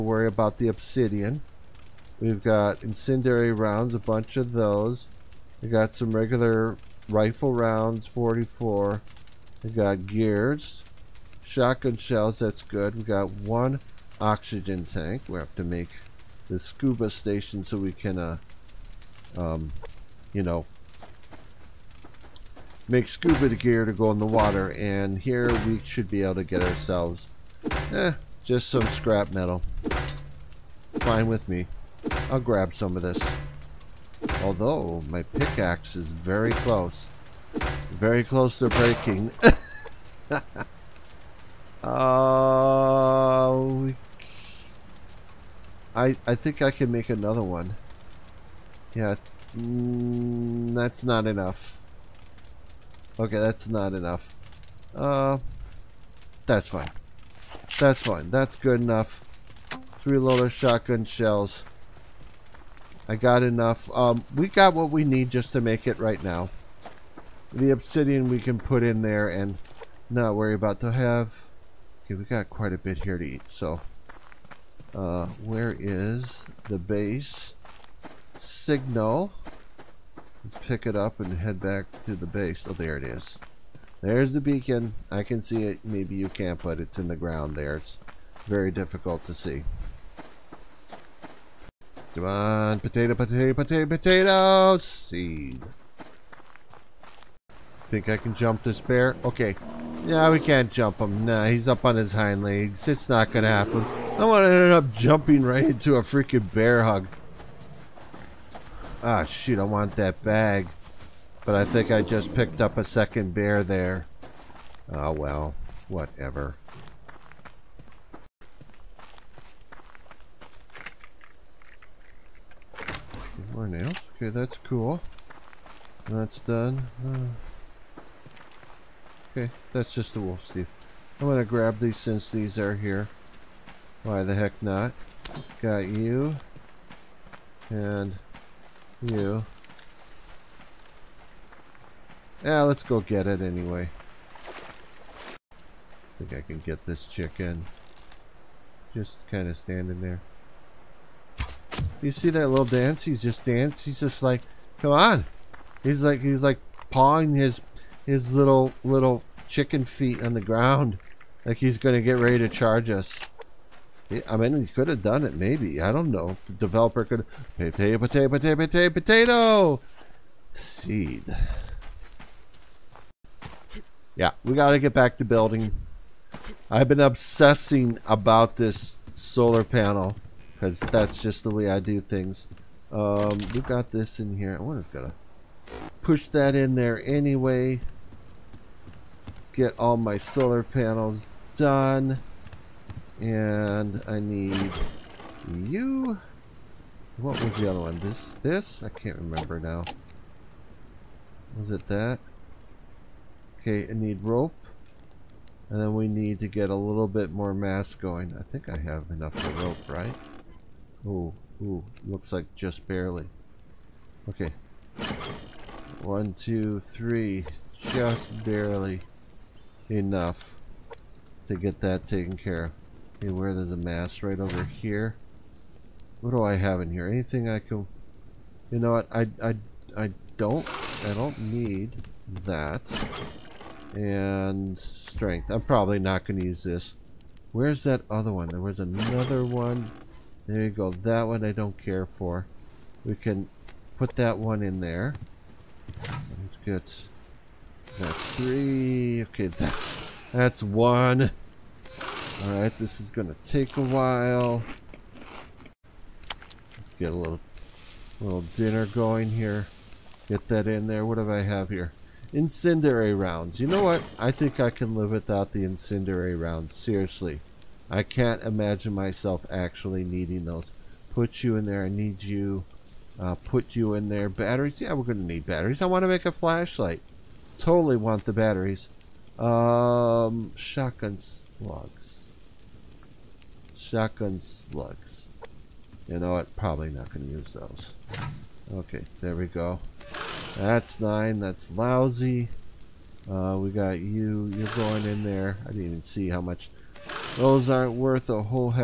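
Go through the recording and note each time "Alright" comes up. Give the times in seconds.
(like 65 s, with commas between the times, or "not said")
252 s.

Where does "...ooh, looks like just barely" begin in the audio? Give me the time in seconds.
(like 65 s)
211 s.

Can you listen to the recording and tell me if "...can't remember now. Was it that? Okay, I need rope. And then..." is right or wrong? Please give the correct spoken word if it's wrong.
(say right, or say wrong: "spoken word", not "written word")
right.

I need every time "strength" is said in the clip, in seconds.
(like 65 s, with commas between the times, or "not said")
234 s.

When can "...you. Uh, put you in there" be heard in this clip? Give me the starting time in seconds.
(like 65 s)
272 s.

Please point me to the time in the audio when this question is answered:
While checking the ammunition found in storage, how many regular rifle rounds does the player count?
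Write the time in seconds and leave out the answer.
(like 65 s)
8 s.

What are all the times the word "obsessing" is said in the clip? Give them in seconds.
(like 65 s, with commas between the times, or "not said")
176 s.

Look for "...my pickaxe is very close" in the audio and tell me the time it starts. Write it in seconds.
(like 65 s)
35 s.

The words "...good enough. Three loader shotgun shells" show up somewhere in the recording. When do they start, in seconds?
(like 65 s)
58 s.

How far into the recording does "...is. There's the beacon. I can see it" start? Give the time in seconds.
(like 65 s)
83 s.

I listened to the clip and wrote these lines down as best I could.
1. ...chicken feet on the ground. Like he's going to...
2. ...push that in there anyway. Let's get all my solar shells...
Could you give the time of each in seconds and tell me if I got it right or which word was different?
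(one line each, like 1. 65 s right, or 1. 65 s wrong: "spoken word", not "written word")
1. 159 s right
2. 186 s wrong: "panels", not "shells".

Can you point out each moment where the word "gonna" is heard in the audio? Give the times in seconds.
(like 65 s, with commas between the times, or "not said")
103 s, 253 s.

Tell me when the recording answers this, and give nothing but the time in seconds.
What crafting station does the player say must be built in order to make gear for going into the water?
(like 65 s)
16 s.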